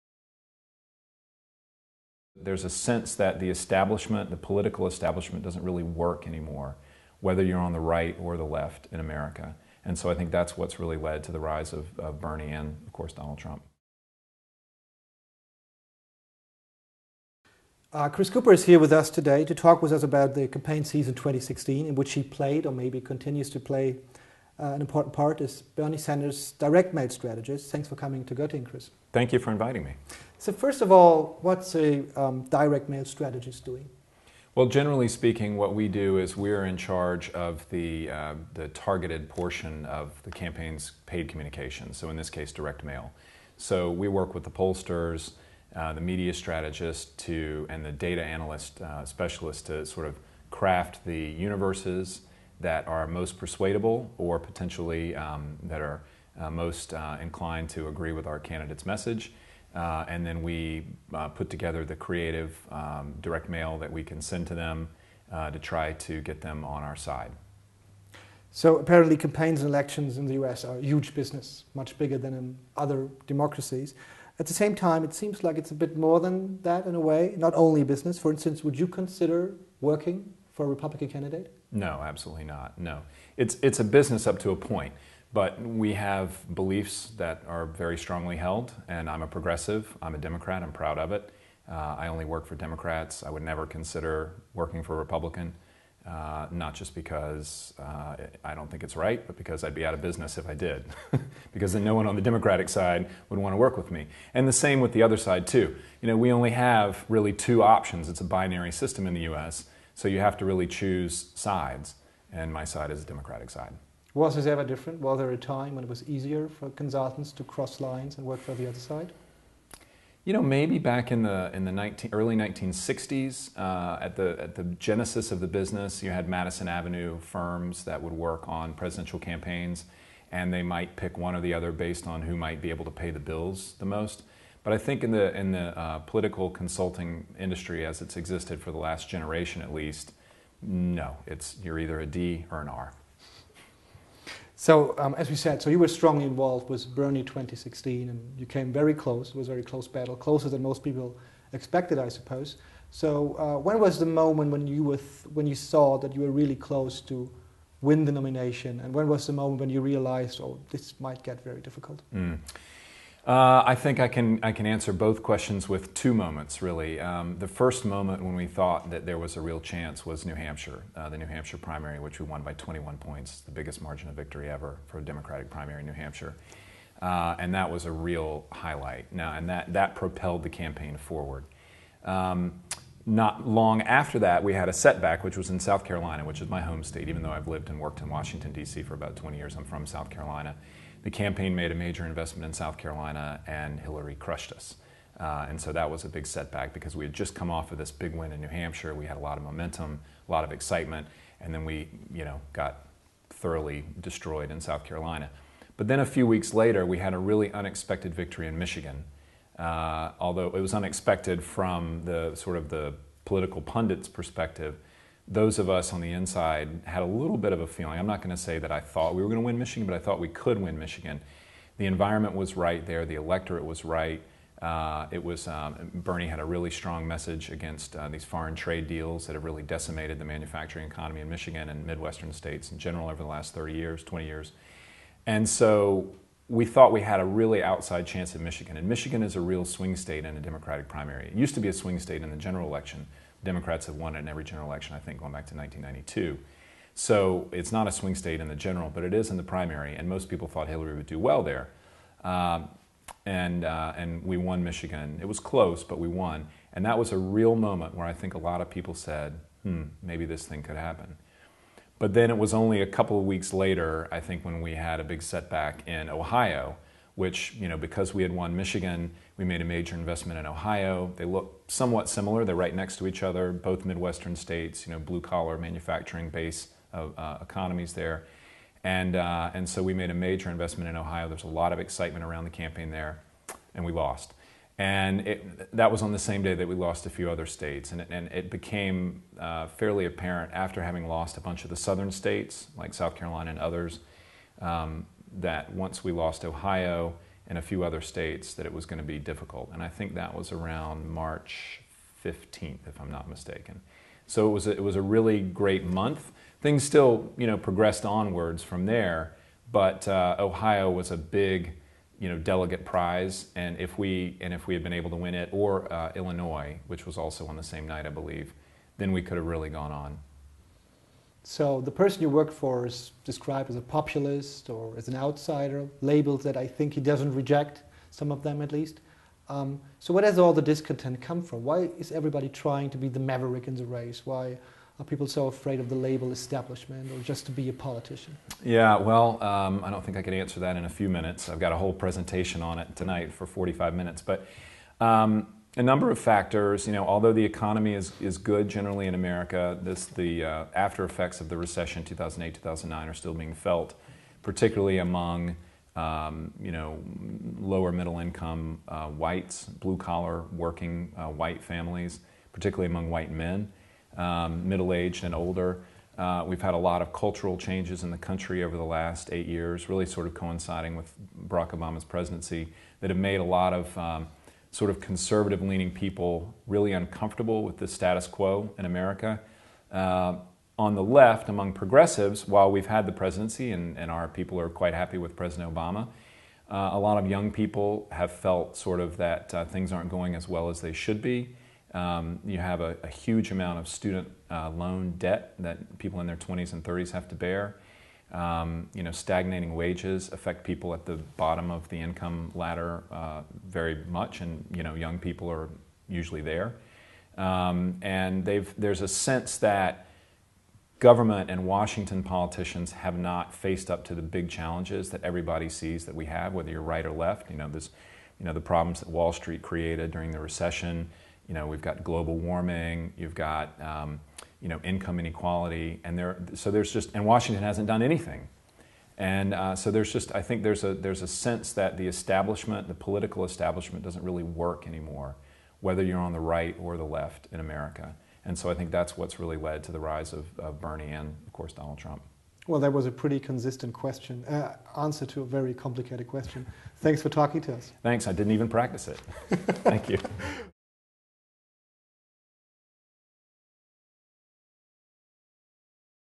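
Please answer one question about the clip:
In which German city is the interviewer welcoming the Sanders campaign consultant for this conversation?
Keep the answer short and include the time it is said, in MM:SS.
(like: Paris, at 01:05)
Göttingen, at 00:28.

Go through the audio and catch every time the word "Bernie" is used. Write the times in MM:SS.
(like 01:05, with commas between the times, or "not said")
00:12, 00:25, 02:26, 03:45, 07:20.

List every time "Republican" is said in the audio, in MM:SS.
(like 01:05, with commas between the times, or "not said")
01:20, 01:34.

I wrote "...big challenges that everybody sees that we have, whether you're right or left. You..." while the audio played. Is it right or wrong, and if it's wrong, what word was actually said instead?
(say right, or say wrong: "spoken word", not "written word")
right.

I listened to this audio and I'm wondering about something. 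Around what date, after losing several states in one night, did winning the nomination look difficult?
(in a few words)
March 15th.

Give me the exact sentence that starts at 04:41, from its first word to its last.
There's a lot of excitement around the campaign there, and we lost.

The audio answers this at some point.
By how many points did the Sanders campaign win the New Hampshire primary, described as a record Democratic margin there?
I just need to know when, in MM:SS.
02:52.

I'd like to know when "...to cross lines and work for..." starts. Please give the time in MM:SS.
01:57.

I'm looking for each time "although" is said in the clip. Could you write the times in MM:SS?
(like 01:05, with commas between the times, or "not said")
03:30, 05:47.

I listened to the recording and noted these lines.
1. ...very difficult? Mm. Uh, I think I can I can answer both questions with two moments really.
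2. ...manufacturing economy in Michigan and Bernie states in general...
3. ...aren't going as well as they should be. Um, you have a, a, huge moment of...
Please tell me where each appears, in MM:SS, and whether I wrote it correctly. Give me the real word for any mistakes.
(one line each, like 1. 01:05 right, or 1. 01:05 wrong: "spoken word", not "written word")
1. 02:41 right
2. 03:50 wrong: "Midwestern", not "Bernie"
3. 06:29 wrong: "amount", not "moment".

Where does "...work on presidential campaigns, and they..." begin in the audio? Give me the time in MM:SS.
02:08.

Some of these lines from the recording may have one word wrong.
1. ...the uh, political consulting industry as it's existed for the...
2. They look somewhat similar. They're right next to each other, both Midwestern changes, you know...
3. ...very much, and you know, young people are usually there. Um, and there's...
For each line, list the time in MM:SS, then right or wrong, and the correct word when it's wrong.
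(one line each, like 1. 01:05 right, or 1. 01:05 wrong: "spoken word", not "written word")
1. 02:15 right
2. 04:31 wrong: "states", not "changes"
3. 06:43 right.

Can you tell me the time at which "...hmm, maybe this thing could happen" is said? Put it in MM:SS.
04:19.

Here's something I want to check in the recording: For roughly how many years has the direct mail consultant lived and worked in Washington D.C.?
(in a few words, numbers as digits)
About 20 years.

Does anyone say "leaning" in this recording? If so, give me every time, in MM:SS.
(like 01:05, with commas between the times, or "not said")
06:15.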